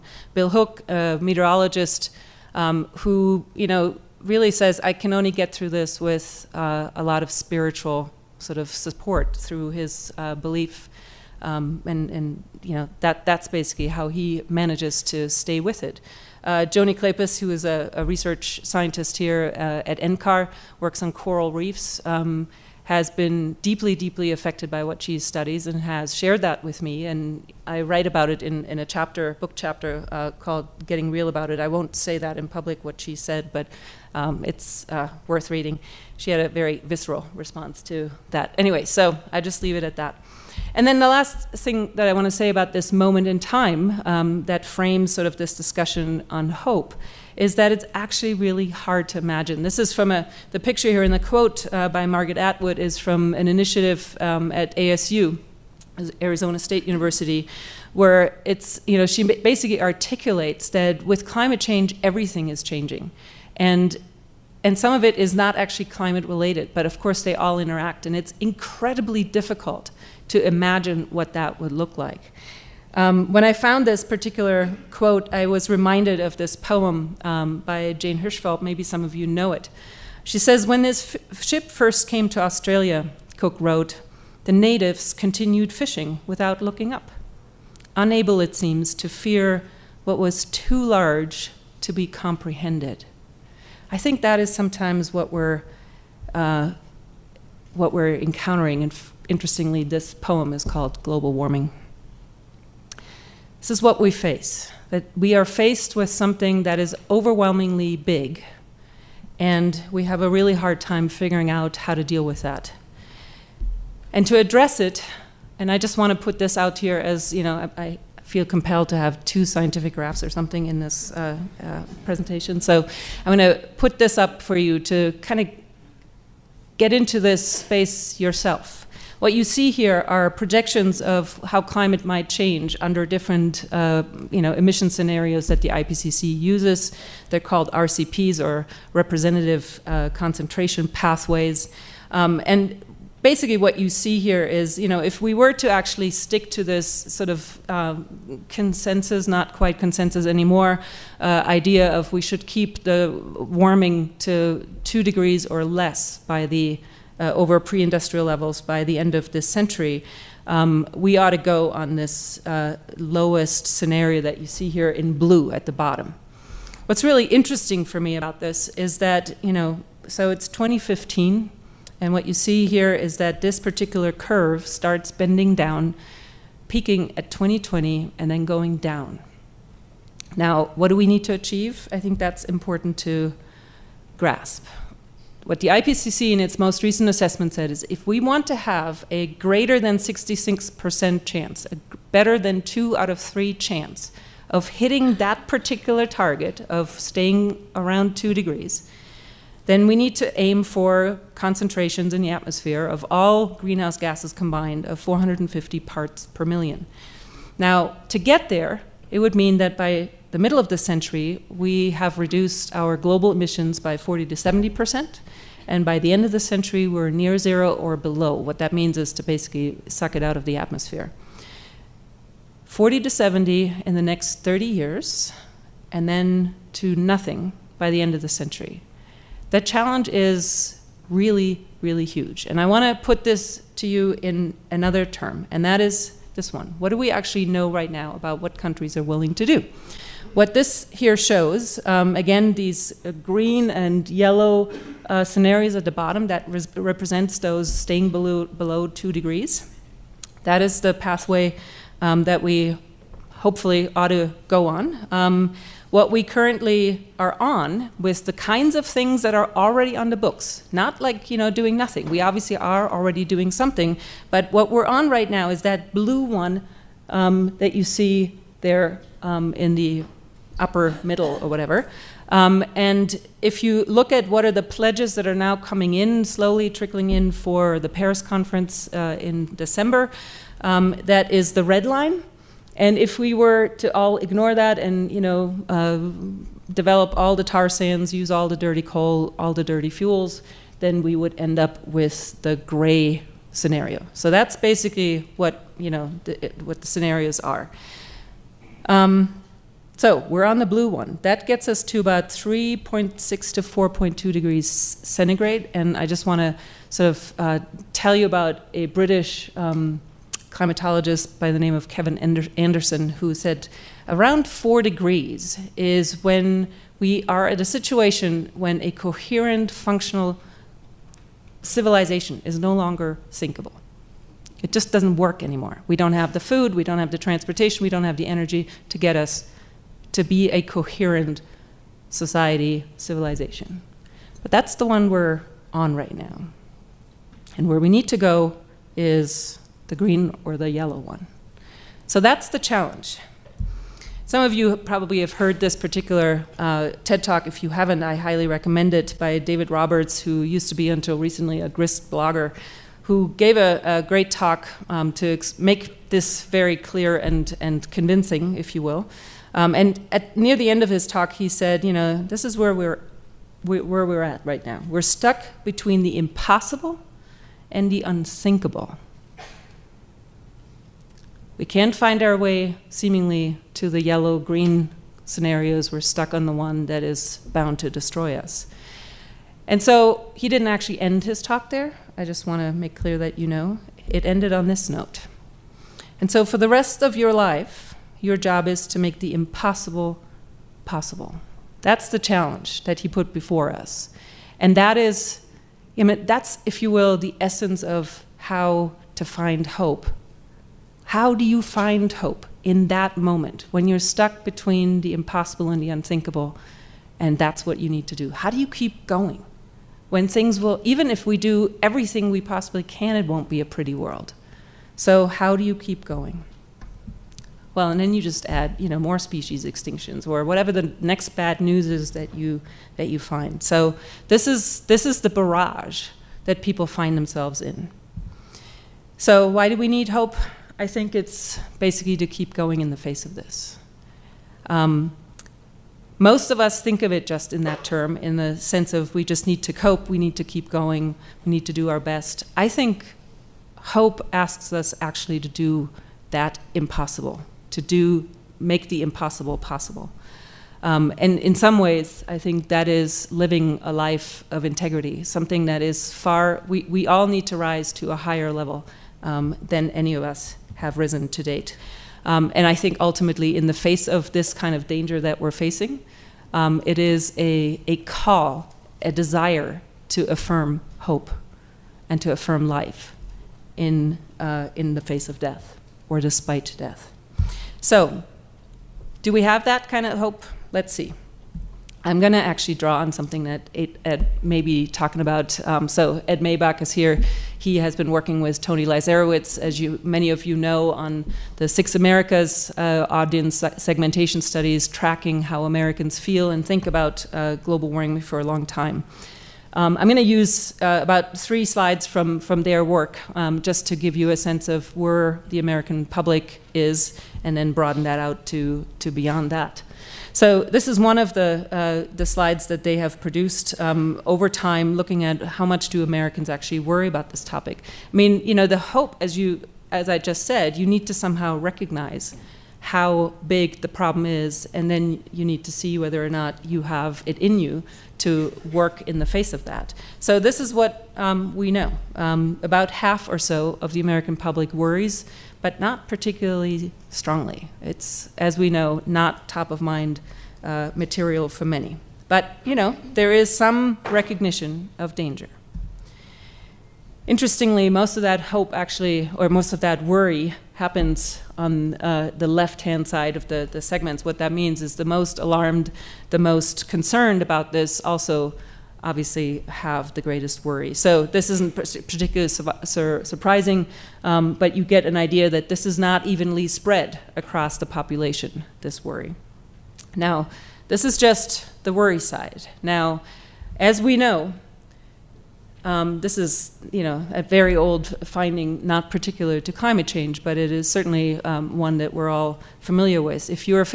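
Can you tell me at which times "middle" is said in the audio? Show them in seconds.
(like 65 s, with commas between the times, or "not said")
210 s, 271 s.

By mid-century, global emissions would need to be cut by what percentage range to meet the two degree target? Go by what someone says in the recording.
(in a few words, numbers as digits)
40 to 70 percent.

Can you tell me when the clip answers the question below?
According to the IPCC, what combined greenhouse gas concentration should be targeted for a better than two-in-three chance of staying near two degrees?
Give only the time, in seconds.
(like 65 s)
204 s.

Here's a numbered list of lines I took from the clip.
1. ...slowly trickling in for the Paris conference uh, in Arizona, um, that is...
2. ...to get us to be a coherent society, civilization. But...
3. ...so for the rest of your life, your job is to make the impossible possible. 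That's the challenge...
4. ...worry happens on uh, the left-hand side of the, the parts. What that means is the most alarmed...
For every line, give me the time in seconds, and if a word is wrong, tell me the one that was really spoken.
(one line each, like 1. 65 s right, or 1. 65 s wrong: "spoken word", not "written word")
1. 276 s wrong: "December", not "Arizona"
2. 328 s right
3. 386 s right
4. 550 s wrong: "segments", not "parts".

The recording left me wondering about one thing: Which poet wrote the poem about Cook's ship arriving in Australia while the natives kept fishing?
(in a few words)
Jane Hirshfield.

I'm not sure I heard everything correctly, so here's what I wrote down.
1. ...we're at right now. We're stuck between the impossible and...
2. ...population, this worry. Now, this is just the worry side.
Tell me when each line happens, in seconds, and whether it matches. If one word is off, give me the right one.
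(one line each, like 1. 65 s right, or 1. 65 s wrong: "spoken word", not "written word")
1. 364 s right
2. 567 s right.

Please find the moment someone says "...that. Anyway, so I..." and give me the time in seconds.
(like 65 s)
38 s.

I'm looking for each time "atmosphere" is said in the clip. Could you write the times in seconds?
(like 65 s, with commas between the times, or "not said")
202 s, 220 s.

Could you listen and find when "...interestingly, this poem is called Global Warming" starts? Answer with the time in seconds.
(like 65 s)
99 s.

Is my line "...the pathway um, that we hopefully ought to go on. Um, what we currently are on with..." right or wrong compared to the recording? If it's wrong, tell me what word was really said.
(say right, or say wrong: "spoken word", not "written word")
right.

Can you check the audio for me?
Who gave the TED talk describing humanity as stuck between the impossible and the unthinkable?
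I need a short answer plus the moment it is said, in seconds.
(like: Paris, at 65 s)
David Roberts, at 349 s.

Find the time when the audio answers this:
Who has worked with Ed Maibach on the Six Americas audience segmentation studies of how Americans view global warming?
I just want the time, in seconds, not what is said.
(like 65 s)
488 s.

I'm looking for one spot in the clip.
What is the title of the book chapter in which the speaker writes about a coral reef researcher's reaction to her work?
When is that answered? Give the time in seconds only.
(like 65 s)
30 s.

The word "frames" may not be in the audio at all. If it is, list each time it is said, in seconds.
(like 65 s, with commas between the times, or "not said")
44 s.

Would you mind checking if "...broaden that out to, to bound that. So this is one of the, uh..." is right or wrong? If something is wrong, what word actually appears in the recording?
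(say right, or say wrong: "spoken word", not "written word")
wrong: "beyond", not "bound".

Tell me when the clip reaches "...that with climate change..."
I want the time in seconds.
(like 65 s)
60 s.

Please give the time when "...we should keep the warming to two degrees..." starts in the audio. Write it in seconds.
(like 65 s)
152 s.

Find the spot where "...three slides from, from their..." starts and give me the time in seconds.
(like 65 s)
501 s.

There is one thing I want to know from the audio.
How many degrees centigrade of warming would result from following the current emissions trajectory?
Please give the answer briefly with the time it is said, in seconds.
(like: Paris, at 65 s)
3.6 to 4.2, at 302 s.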